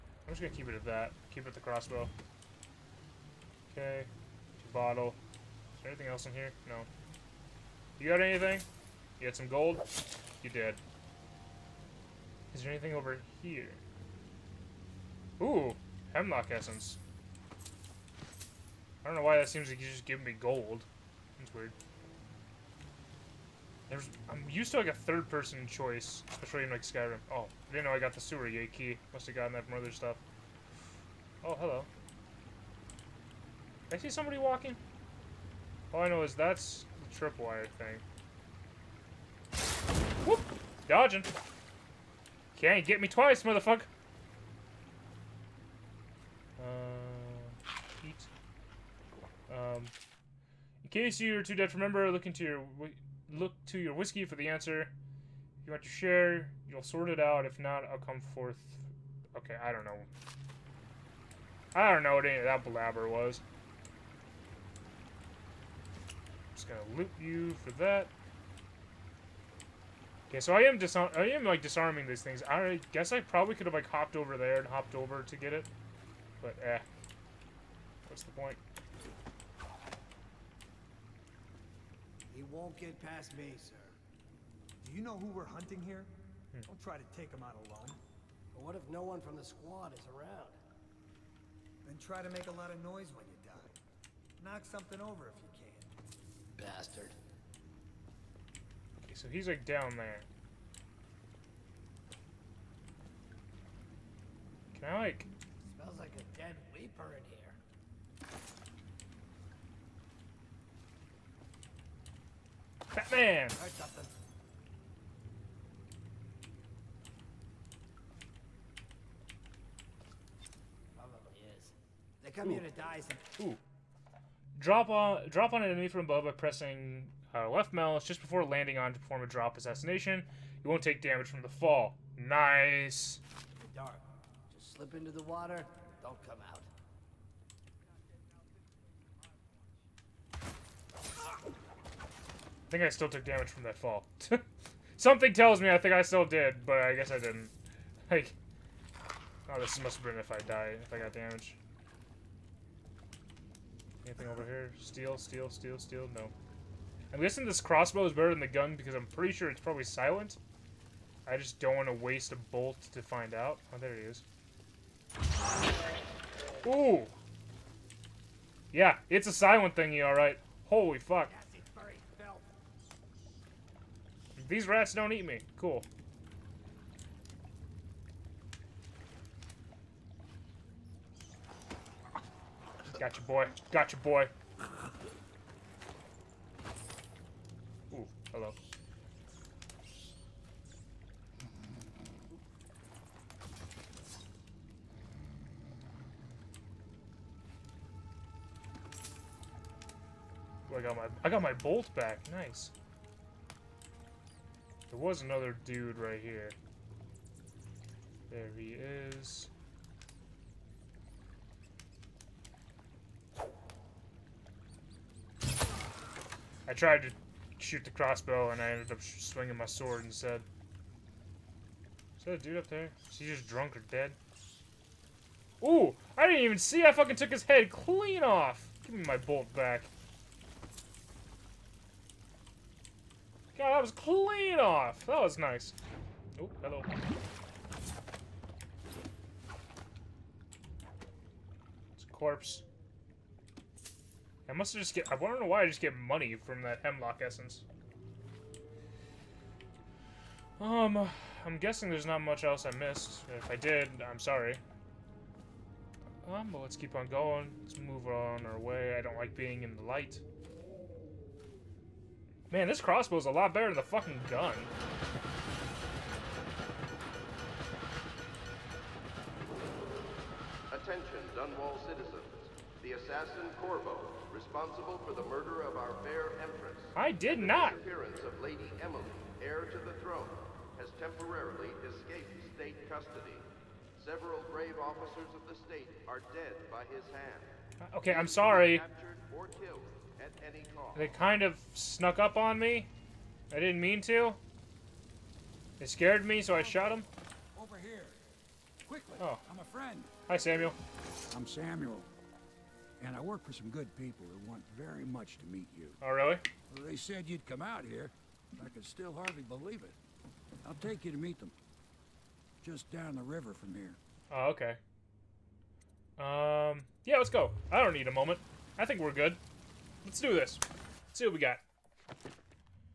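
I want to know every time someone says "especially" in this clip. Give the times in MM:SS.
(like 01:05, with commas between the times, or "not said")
00:26.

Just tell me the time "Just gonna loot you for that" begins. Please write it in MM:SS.
01:06.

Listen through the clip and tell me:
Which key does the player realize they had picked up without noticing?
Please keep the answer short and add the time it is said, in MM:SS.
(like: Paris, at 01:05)
sewer gate key, at 00:28.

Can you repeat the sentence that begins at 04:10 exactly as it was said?
Um, I'm guessing there's not much else I missed.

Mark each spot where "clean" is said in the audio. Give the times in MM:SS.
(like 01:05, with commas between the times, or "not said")
03:47, 03:53.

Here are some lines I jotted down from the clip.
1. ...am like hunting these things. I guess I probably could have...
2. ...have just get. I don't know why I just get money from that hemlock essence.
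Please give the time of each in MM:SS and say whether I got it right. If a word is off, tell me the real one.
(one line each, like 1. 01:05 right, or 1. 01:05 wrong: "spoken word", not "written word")
1. 01:11 wrong: "disarming", not "hunting"
2. 04:04 right.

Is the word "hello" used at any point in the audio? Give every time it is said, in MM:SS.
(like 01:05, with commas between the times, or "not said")
00:31, 03:08, 03:56.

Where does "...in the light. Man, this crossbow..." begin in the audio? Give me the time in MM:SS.
04:19.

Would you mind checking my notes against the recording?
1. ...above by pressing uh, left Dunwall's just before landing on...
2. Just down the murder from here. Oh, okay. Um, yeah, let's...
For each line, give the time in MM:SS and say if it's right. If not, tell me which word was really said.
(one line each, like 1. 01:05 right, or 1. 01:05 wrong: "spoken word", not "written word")
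1. 02:06 wrong: "Mel", not "Dunwall"
2. 05:12 wrong: "river", not "murder".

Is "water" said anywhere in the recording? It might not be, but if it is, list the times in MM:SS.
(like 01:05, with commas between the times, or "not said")
02:15.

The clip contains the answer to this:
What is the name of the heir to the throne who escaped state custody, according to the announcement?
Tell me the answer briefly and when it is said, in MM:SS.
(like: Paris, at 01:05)
Lady Emily, at 04:38.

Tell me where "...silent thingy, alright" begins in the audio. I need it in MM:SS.
02:49.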